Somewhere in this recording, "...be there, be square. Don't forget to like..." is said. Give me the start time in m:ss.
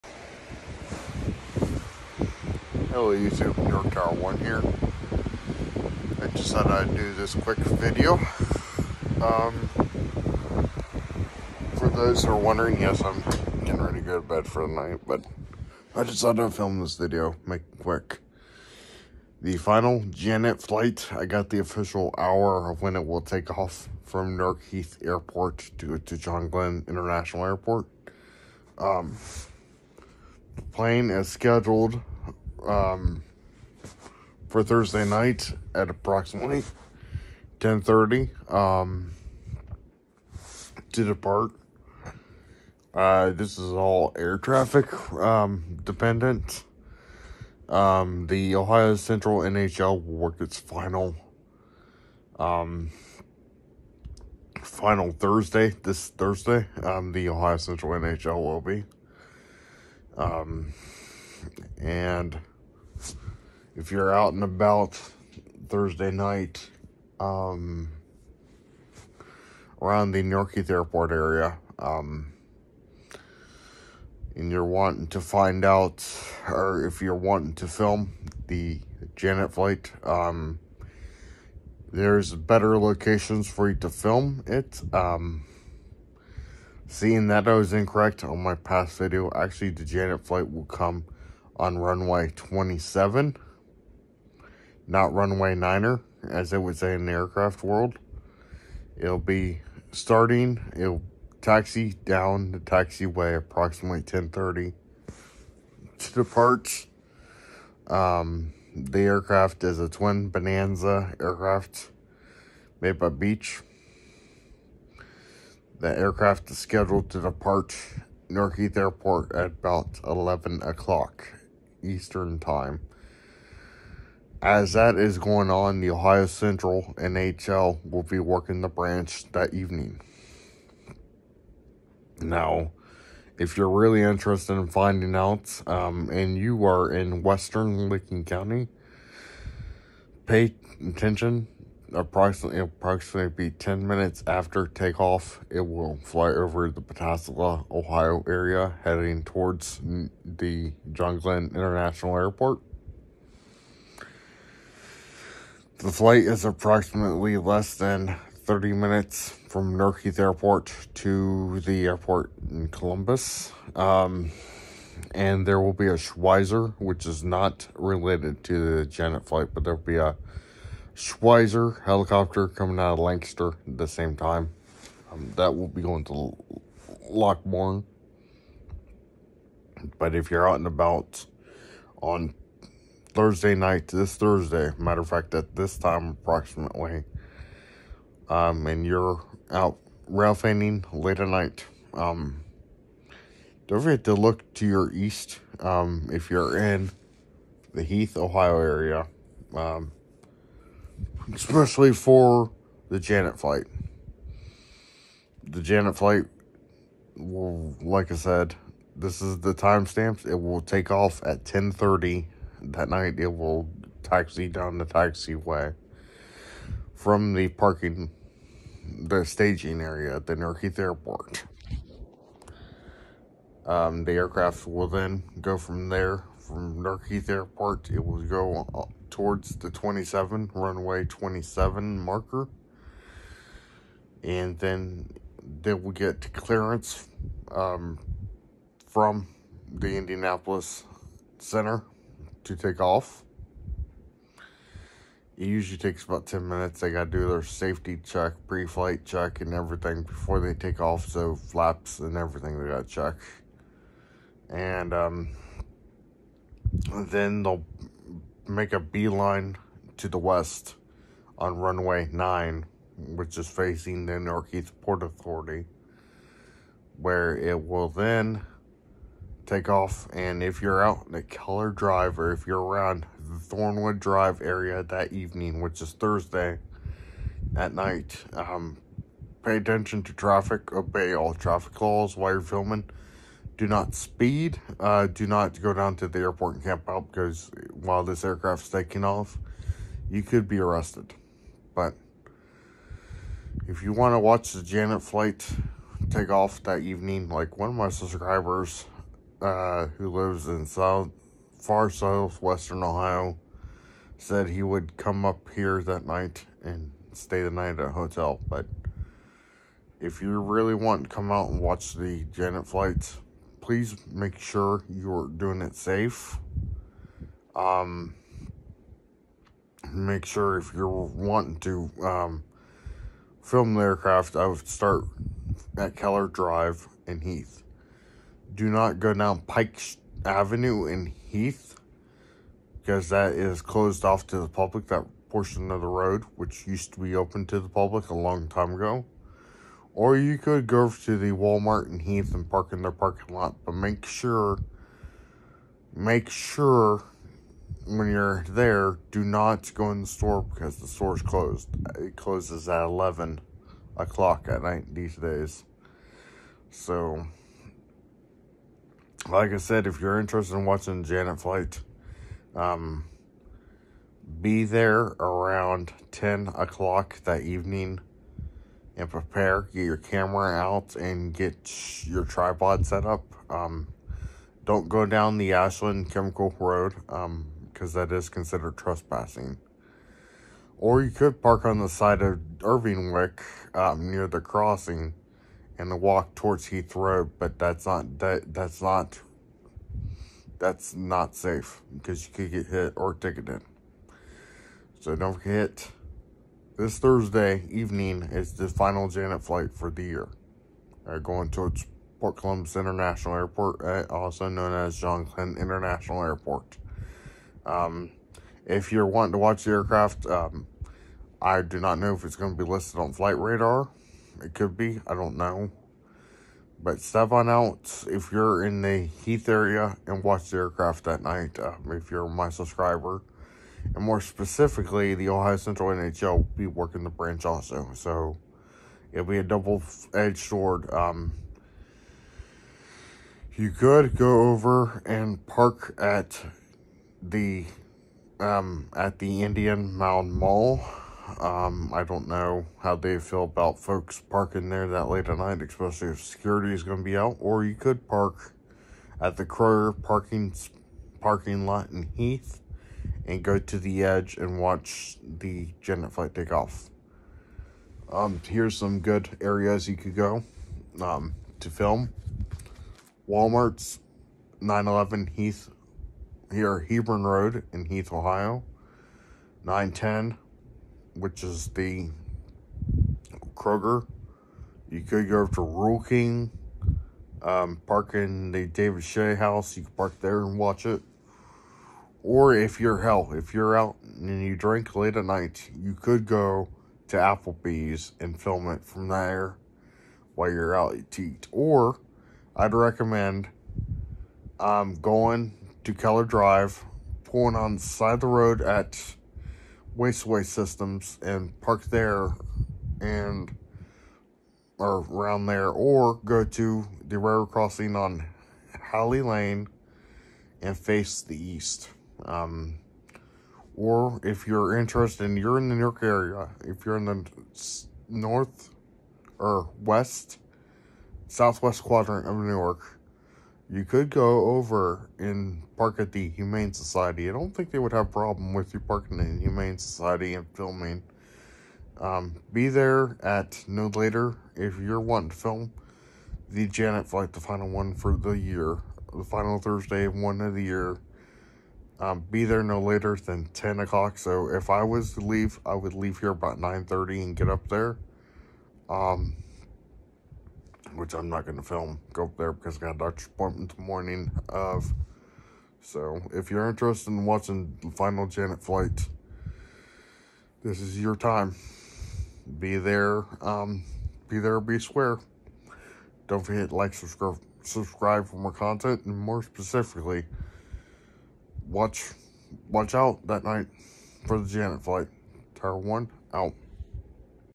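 9:24.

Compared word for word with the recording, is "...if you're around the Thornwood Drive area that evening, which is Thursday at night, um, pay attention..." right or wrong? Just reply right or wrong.
right.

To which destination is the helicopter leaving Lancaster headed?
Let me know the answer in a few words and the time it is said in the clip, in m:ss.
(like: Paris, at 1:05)
Lockbourne, at 2:57.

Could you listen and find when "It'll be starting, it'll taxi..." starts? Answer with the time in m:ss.
1:38.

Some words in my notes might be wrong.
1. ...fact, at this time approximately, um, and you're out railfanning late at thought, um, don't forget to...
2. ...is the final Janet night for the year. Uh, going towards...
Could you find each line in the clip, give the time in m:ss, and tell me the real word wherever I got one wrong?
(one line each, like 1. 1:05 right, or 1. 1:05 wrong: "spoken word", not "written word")
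1. 3:05 wrong: "night", not "thought"
2. 6:38 wrong: "flight", not "night".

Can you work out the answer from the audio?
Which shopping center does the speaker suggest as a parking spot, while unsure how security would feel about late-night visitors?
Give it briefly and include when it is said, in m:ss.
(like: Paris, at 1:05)
Indian Mound Mall, at 7:19.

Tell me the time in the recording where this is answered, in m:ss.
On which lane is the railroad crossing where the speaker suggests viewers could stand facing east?
8:28.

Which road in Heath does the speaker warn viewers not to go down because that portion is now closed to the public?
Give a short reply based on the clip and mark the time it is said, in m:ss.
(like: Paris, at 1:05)
Pike Avenue, at 5:29.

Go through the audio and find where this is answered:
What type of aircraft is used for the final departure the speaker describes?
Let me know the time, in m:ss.
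1:49.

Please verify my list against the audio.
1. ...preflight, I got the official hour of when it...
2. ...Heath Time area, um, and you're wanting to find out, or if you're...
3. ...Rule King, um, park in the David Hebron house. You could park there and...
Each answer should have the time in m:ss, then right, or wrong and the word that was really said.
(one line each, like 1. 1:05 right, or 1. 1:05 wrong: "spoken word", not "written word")
1. 0:20 wrong: "flight", not "preflight"
2. 1:10 wrong: "Airport", not "Time"
3. 7:55 wrong: "Shea", not "Hebron".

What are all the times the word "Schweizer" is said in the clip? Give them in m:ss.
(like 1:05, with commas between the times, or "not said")
2:45, 2:50.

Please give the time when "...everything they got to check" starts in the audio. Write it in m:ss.
4:12.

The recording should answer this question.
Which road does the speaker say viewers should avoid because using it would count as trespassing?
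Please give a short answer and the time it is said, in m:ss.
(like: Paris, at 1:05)
Ashland Chemical Road, at 6:15.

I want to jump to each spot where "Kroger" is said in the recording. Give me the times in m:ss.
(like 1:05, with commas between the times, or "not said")
7:29, 7:53.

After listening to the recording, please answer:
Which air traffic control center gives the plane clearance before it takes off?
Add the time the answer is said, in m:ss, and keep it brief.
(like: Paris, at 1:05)
Indianapolis Center, at 3:59.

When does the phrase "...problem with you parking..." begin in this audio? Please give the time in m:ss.
8:48.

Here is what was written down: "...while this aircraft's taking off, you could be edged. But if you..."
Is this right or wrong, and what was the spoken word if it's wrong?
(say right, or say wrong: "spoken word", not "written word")
wrong: "arrested", not "edged".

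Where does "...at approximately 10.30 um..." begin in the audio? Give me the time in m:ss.
0:35.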